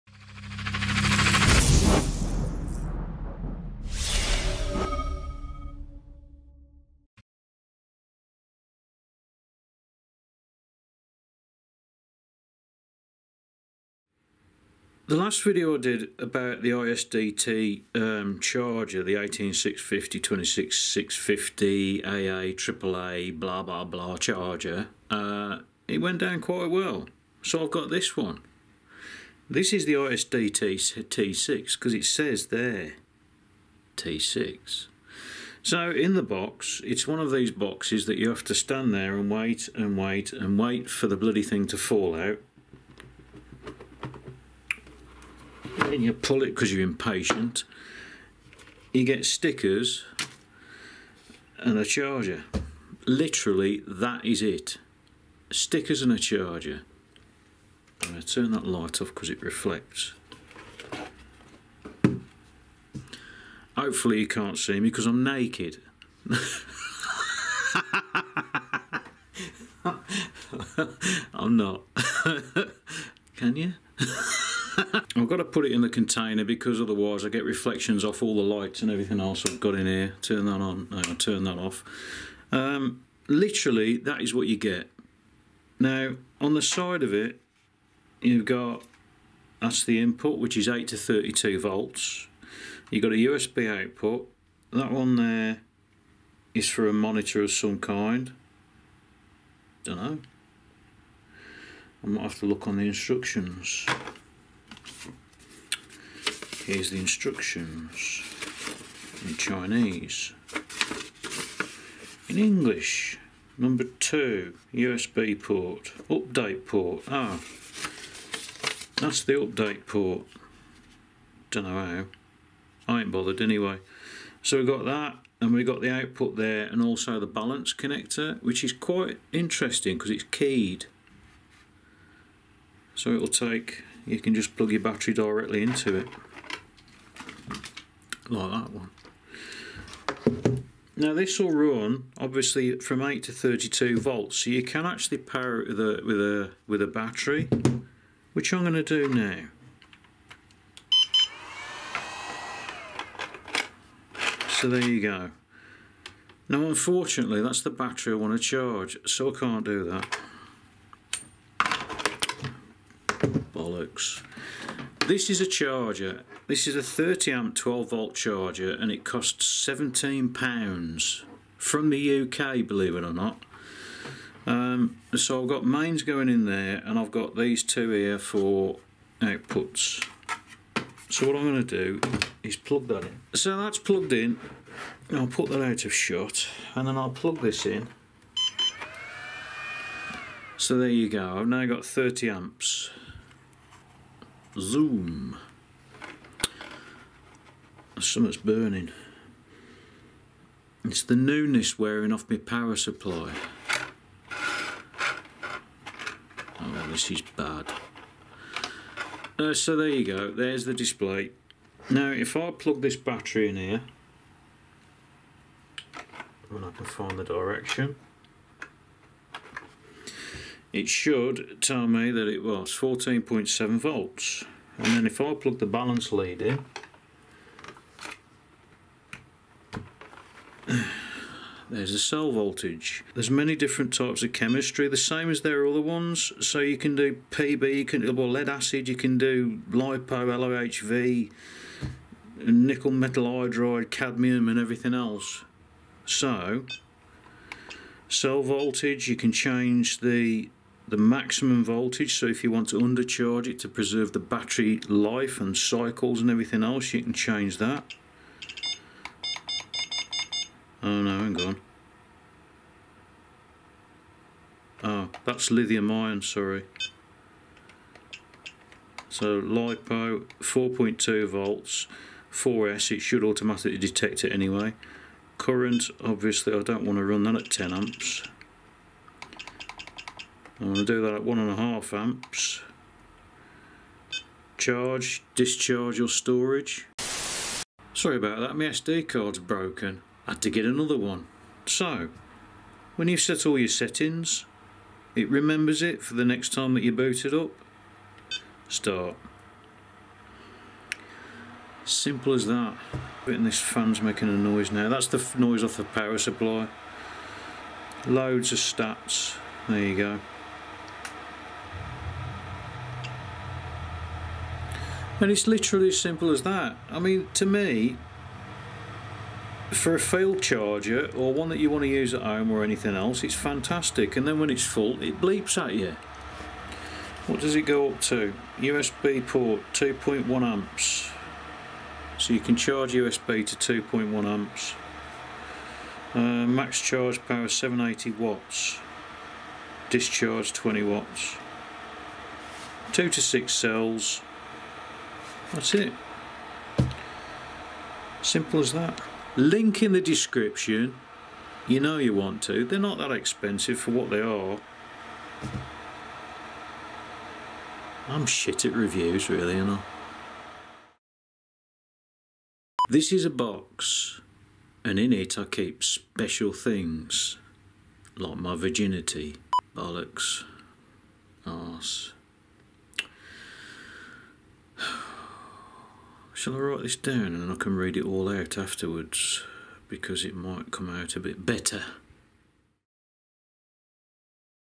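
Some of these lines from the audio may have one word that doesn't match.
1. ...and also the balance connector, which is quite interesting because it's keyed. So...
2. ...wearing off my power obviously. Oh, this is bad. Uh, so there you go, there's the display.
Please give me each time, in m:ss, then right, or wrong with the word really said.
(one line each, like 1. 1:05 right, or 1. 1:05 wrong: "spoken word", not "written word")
1. 2:06 right
2. 3:21 wrong: "supply", not "obviously".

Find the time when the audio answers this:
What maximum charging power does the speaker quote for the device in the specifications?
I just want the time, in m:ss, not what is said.
5:37.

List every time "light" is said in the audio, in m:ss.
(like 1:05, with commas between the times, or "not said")
0:58, 1:18.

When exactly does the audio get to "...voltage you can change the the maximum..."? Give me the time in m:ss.
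4:08.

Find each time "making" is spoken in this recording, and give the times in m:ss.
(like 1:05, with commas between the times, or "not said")
5:04.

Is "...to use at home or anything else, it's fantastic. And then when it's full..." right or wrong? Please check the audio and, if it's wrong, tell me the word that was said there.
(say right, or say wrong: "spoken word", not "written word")
right.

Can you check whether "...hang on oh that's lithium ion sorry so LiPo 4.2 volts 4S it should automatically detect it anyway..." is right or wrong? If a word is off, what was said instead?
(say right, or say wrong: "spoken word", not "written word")
right.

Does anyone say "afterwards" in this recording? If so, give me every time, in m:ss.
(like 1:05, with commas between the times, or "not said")
6:18.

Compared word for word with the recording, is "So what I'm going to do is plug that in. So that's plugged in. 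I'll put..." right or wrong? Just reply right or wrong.
right.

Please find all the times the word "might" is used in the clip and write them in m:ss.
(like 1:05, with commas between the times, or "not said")
1:42, 6:20.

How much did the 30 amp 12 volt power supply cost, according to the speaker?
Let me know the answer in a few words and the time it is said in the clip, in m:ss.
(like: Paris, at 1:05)
17 pounds, at 2:49.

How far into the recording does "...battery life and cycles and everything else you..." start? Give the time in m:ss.
4:14.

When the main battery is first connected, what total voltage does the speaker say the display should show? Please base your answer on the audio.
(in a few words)
14.7 volts.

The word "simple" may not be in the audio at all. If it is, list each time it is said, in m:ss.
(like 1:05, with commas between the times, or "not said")
5:01, 5:16, 5:48.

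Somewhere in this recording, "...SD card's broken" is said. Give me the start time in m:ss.
4:48.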